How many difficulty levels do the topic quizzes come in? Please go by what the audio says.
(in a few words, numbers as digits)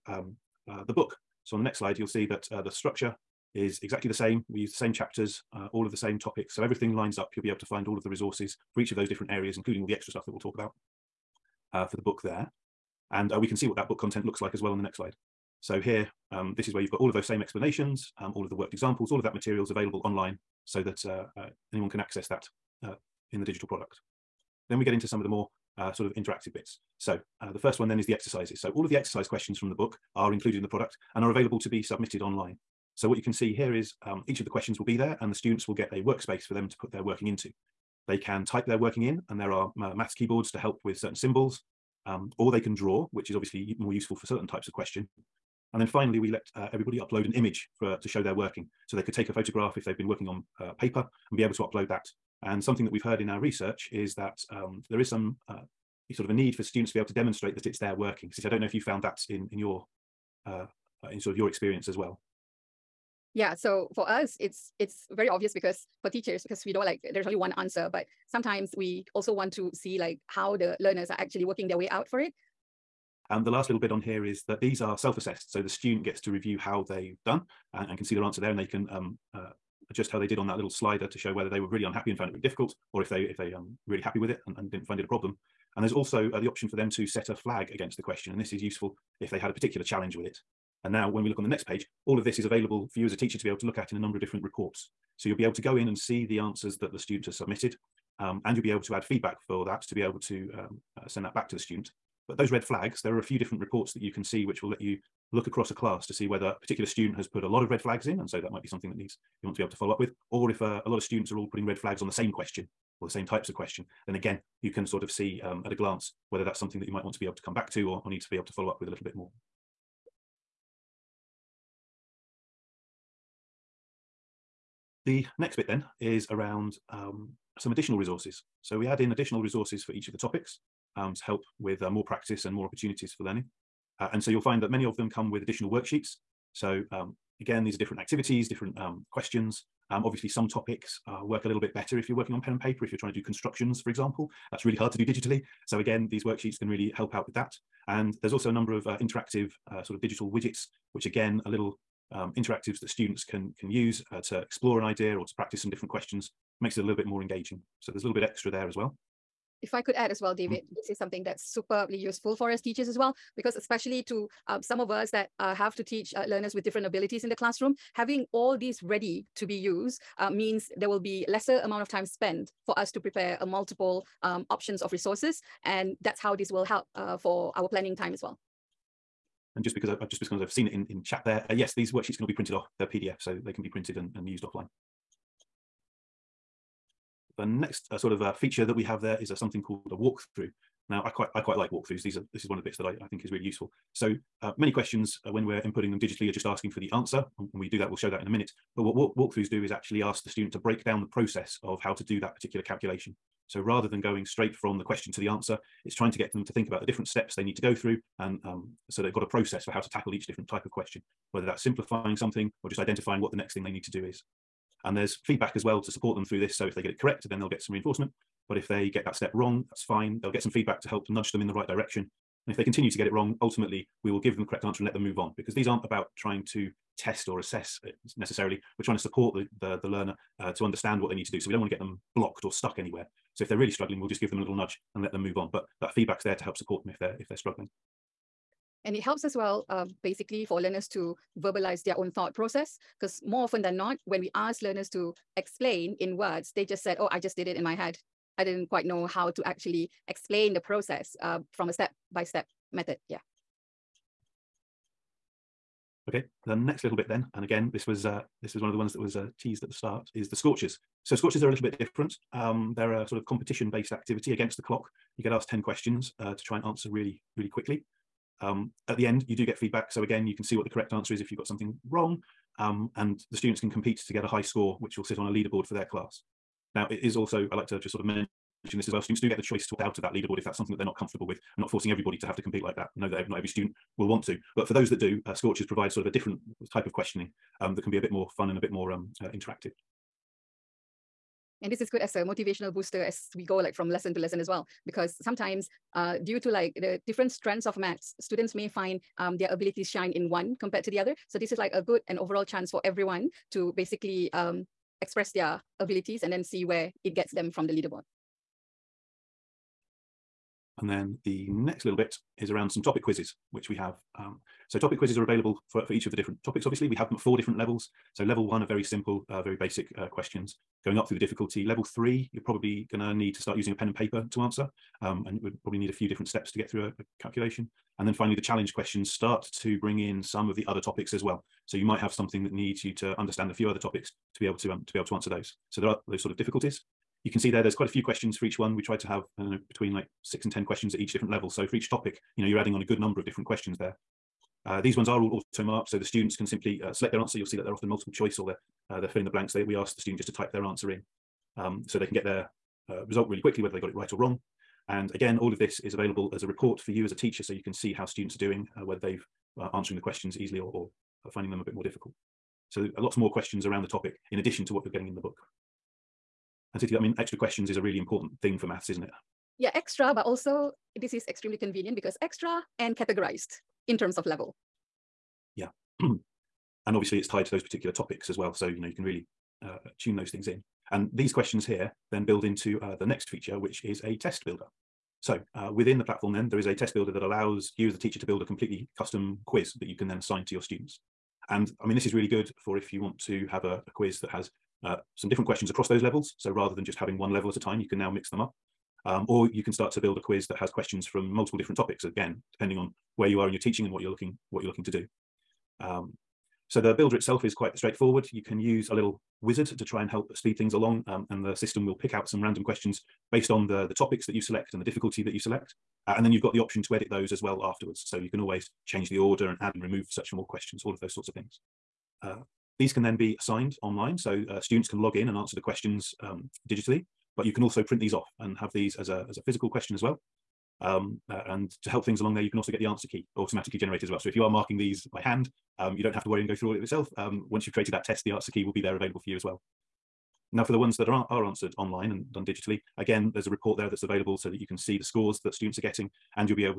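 4.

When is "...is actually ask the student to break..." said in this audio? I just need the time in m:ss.
3:19.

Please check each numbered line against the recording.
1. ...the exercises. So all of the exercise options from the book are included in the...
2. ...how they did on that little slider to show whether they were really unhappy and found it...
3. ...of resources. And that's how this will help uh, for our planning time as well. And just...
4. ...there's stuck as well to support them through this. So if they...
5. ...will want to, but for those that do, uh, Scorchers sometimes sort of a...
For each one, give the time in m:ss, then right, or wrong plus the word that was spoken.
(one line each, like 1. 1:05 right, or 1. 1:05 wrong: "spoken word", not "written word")
1. 0:28 wrong: "questions", not "options"
2. 1:20 right
3. 2:54 right
4. 3:34 wrong: "feedback", not "stuck"
5. 4:43 wrong: "provides", not "sometimes".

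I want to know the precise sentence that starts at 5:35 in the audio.
So there are those sort of difficulties.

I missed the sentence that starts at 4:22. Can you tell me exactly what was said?
Um, they're a sort of competition-based activity against the clock.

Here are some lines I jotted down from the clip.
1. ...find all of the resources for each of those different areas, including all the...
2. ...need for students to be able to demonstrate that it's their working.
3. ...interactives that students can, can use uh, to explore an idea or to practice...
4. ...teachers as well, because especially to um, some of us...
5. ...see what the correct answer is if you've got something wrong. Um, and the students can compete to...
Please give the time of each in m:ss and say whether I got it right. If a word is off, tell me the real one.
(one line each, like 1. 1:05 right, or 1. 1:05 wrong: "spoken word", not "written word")
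1. 0:07 right
2. 0:56 right
3. 2:32 right
4. 2:42 right
5. 4:30 right.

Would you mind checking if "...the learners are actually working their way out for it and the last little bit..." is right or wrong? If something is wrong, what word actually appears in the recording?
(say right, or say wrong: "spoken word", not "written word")
right.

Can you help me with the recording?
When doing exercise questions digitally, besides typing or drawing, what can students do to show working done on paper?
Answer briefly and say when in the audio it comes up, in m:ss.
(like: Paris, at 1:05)
Upload an image, at 0:46.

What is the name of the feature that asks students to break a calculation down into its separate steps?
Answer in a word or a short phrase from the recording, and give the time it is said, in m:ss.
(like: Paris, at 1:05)
Walkthrough, at 3:09.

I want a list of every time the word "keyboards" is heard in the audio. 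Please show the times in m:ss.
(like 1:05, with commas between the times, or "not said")
0:40.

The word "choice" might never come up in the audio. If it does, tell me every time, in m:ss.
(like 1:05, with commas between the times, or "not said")
4:39, 5:48.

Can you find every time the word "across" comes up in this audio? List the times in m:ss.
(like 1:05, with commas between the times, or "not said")
1:45, 6:35.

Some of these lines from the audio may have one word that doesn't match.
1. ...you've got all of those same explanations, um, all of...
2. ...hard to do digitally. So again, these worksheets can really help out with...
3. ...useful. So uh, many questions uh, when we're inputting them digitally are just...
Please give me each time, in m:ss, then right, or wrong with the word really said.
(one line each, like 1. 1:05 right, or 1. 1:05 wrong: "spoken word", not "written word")
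1. 0:16 right
2. 2:24 right
3. 3:13 right.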